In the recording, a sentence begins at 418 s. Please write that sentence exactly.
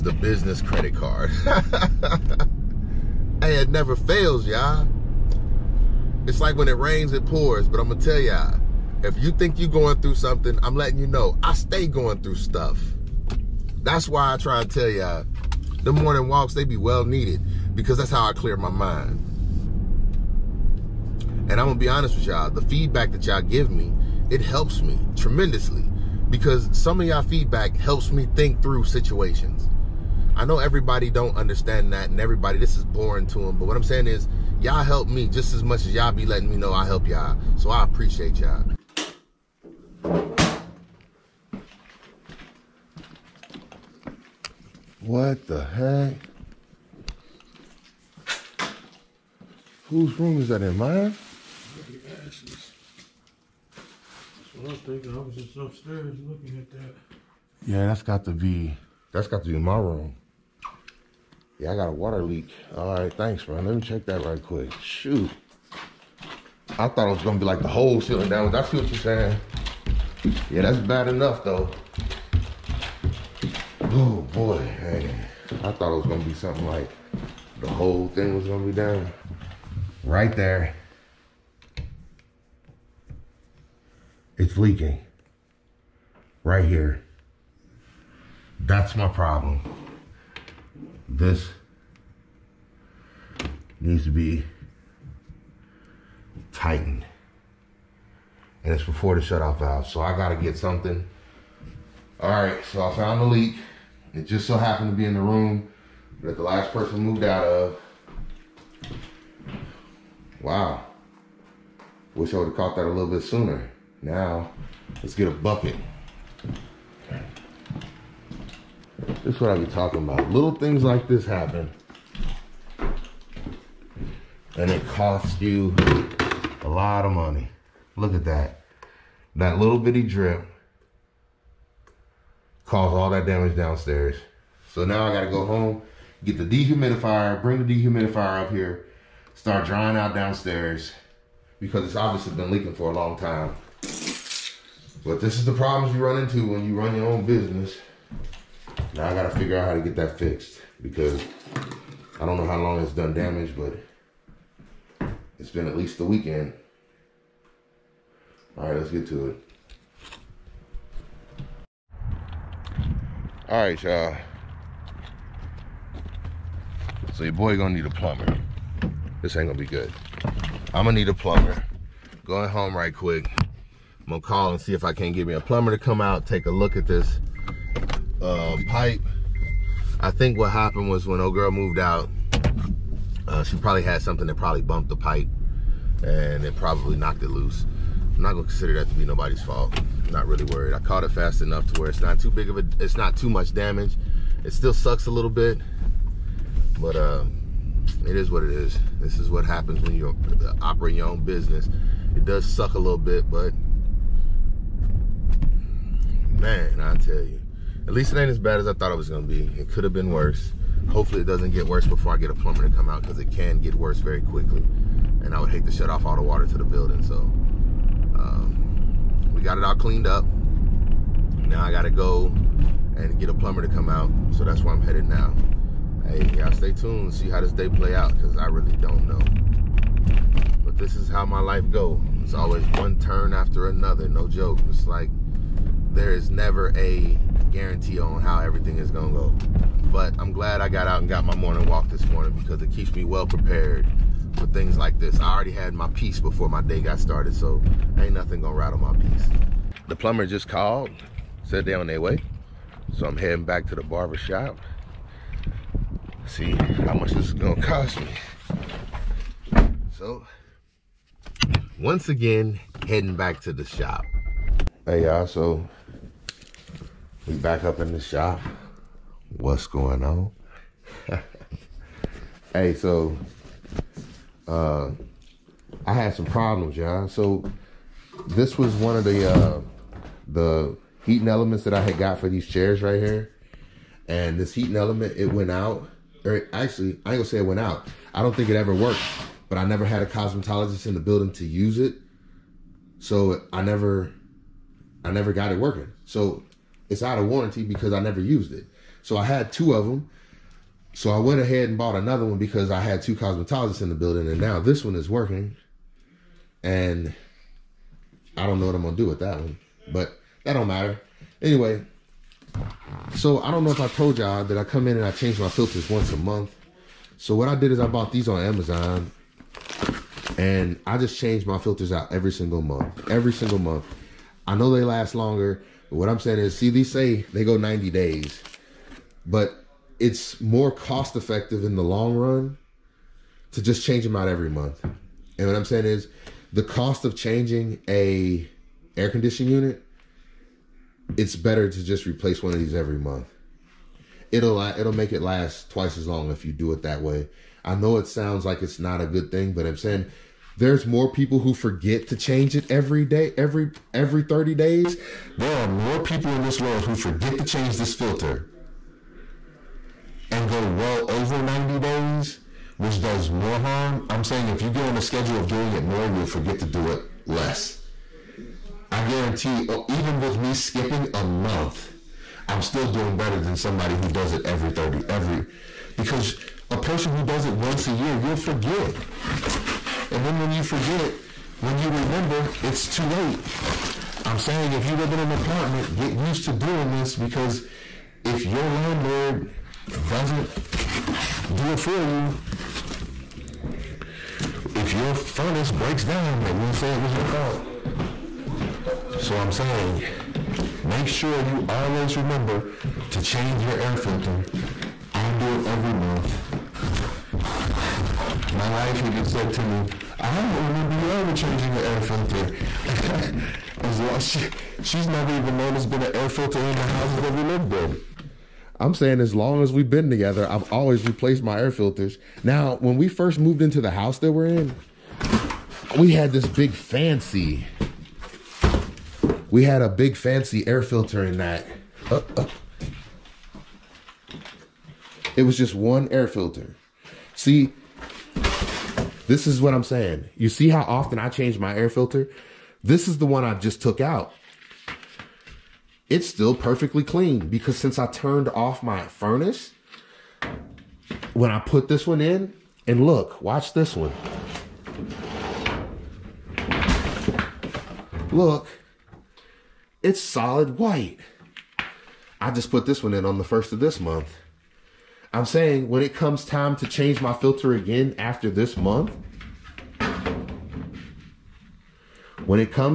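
I'm saying as long as we've been together, I've always replaced my air filters.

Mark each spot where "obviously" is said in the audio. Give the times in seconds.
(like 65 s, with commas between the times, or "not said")
141 s.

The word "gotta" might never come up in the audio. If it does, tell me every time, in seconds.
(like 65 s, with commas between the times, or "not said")
100 s, 135 s, 149 s, 221 s.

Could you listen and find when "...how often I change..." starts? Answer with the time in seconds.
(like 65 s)
440 s.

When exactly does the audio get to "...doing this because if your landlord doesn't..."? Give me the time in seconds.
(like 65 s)
386 s.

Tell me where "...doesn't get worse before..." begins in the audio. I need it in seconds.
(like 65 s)
211 s.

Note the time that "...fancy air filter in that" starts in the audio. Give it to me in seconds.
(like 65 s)
430 s.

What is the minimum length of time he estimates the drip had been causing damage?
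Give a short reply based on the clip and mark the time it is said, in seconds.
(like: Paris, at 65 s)
The weekend, at 155 s.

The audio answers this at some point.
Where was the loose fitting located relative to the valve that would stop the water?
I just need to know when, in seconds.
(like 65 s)
98 s.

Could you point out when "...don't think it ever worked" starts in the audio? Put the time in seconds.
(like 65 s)
288 s.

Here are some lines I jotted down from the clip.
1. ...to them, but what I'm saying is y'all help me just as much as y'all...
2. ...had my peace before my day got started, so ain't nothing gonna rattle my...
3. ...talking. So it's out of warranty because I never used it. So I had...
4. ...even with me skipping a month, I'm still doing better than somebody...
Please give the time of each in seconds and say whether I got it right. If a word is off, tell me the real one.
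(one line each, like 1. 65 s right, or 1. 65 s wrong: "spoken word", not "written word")
1. 33 s right
2. 245 s right
3. 295 s wrong: "working", not "talking"
4. 369 s right.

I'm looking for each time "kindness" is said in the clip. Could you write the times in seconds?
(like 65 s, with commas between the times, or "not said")
not said.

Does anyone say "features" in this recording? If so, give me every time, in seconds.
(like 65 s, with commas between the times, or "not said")
not said.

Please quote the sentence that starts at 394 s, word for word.
If your furnace breaks down, they will say it was your fault.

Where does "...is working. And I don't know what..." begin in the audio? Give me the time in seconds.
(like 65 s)
304 s.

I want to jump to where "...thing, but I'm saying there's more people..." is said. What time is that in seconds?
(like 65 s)
349 s.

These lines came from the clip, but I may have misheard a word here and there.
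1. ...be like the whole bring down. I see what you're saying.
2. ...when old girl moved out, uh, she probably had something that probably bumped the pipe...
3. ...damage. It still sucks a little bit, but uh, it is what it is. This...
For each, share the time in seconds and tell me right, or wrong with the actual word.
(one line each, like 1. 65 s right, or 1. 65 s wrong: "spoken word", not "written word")
1. 67 s wrong: "ceiling", not "bring"
2. 181 s right
3. 193 s right.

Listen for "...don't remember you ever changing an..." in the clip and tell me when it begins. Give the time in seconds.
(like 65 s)
410 s.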